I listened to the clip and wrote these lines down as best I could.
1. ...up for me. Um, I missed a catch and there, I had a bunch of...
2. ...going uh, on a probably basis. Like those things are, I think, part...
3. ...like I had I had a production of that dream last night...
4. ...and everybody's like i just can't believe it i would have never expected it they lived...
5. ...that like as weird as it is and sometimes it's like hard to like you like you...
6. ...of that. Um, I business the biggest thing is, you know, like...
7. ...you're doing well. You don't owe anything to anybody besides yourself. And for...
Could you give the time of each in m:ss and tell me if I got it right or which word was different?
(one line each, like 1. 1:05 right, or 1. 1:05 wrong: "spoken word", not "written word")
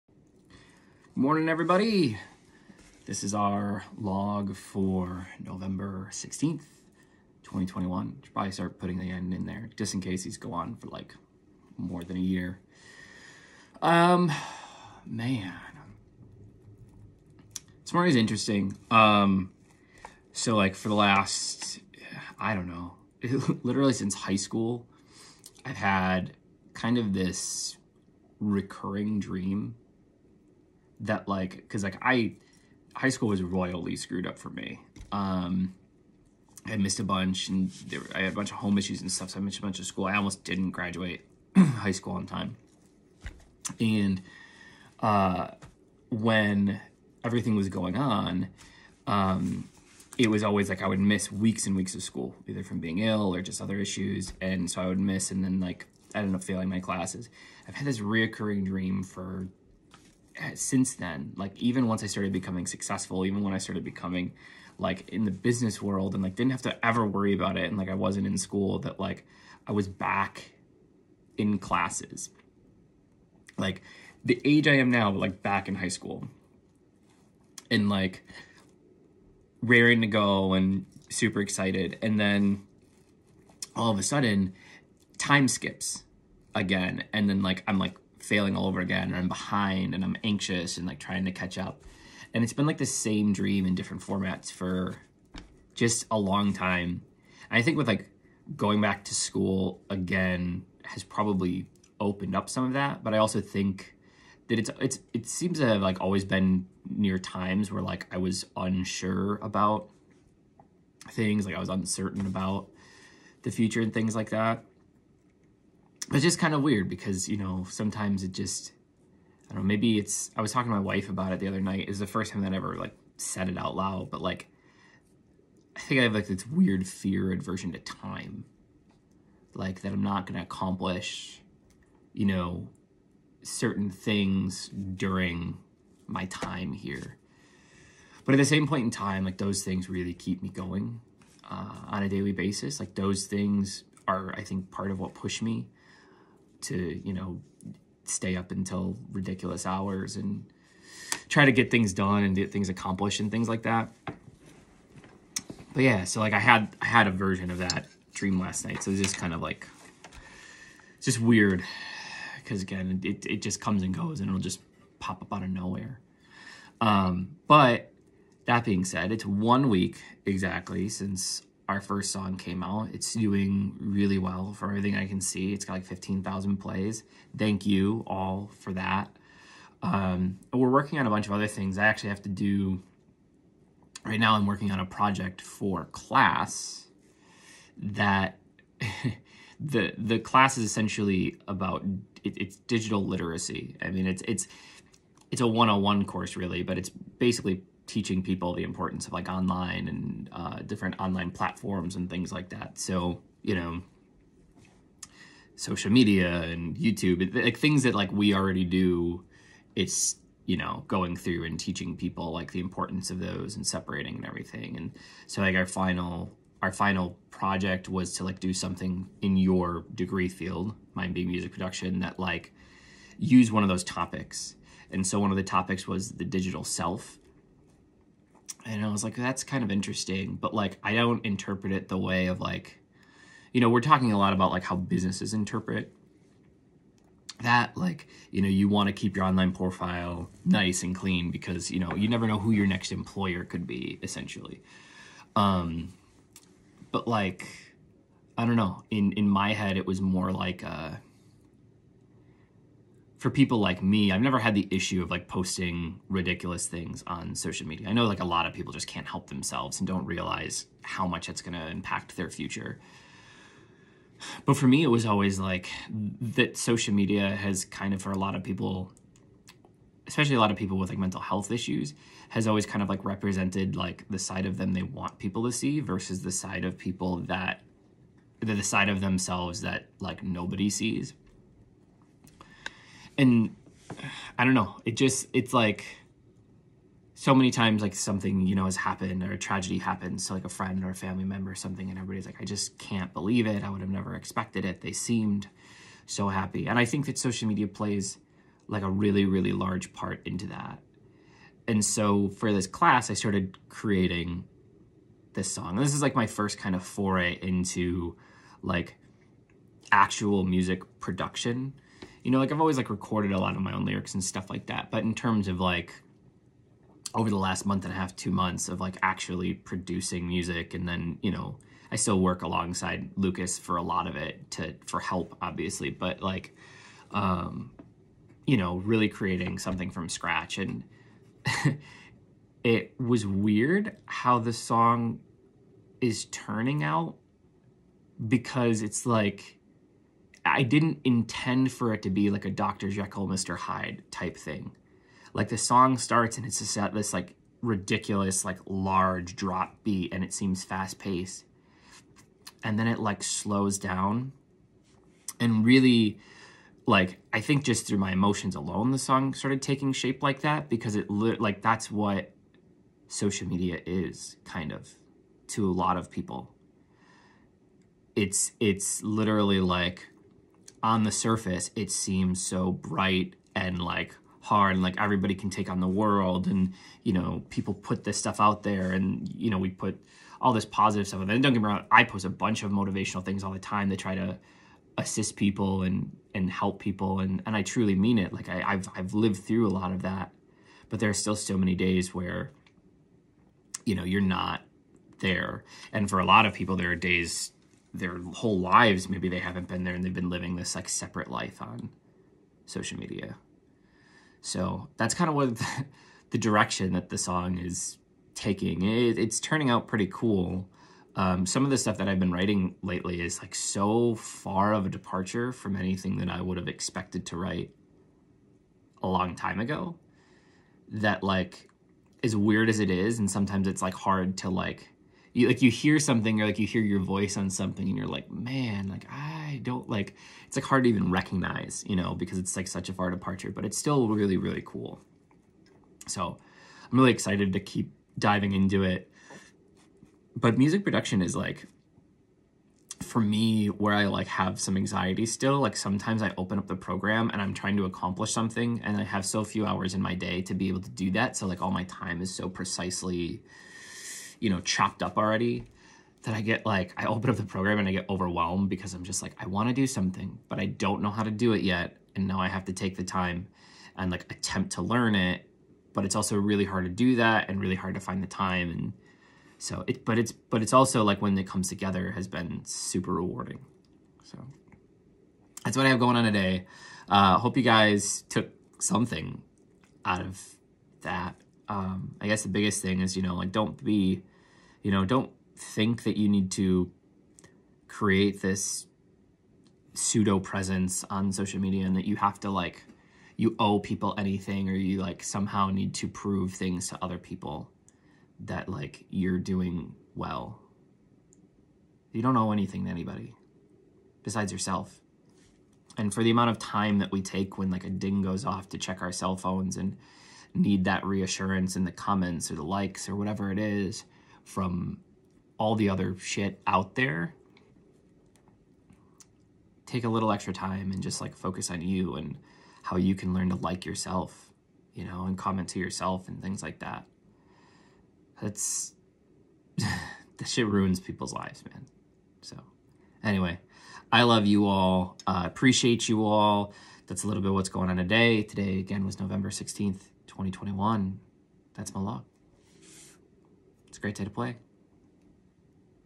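1. 0:34 wrong: "bunch", not "catch"
2. 2:20 wrong: "daily", not "probably"
3. 2:36 wrong: "version", not "production"
4. 4:51 wrong: "seemed", not "lived"
5. 7:00 right
6. 8:00 wrong: "guess", not "business"
7. 8:19 right.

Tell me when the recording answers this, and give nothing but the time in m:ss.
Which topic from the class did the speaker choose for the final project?
3:46.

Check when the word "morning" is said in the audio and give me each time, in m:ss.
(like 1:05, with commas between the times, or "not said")
0:01, 0:17.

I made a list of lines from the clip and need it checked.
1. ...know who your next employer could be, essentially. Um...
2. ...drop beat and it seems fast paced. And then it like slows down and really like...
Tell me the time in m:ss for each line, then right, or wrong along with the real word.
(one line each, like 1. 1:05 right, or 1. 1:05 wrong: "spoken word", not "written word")
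1. 4:02 right
2. 5:49 right.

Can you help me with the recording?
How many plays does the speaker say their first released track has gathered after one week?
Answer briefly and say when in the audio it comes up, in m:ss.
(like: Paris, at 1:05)
15,000, at 2:55.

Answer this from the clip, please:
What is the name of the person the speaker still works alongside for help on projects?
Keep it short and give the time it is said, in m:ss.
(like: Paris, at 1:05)
Lucas, at 5:23.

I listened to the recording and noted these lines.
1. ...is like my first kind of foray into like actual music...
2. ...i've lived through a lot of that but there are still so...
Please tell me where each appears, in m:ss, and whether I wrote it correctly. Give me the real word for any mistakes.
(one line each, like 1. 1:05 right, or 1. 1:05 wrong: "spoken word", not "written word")
1. 5:05 right
2. 6:28 right.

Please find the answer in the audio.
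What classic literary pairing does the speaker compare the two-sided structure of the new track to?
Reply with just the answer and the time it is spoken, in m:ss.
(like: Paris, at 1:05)
Dr. Jekyll, Mr. Hyde, at 5:42.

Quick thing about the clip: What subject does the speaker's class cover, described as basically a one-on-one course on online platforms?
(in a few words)
Digital literacy.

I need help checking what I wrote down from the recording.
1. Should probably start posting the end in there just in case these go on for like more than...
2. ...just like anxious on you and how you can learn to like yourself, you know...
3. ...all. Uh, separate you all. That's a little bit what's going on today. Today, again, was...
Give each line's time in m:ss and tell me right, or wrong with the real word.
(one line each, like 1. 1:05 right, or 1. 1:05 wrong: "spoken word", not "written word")
1. 0:08 wrong: "putting", not "posting"
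2. 8:41 wrong: "focus", not "anxious"
3. 8:54 wrong: "appreciate", not "separate".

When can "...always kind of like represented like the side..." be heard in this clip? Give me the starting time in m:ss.
4:32.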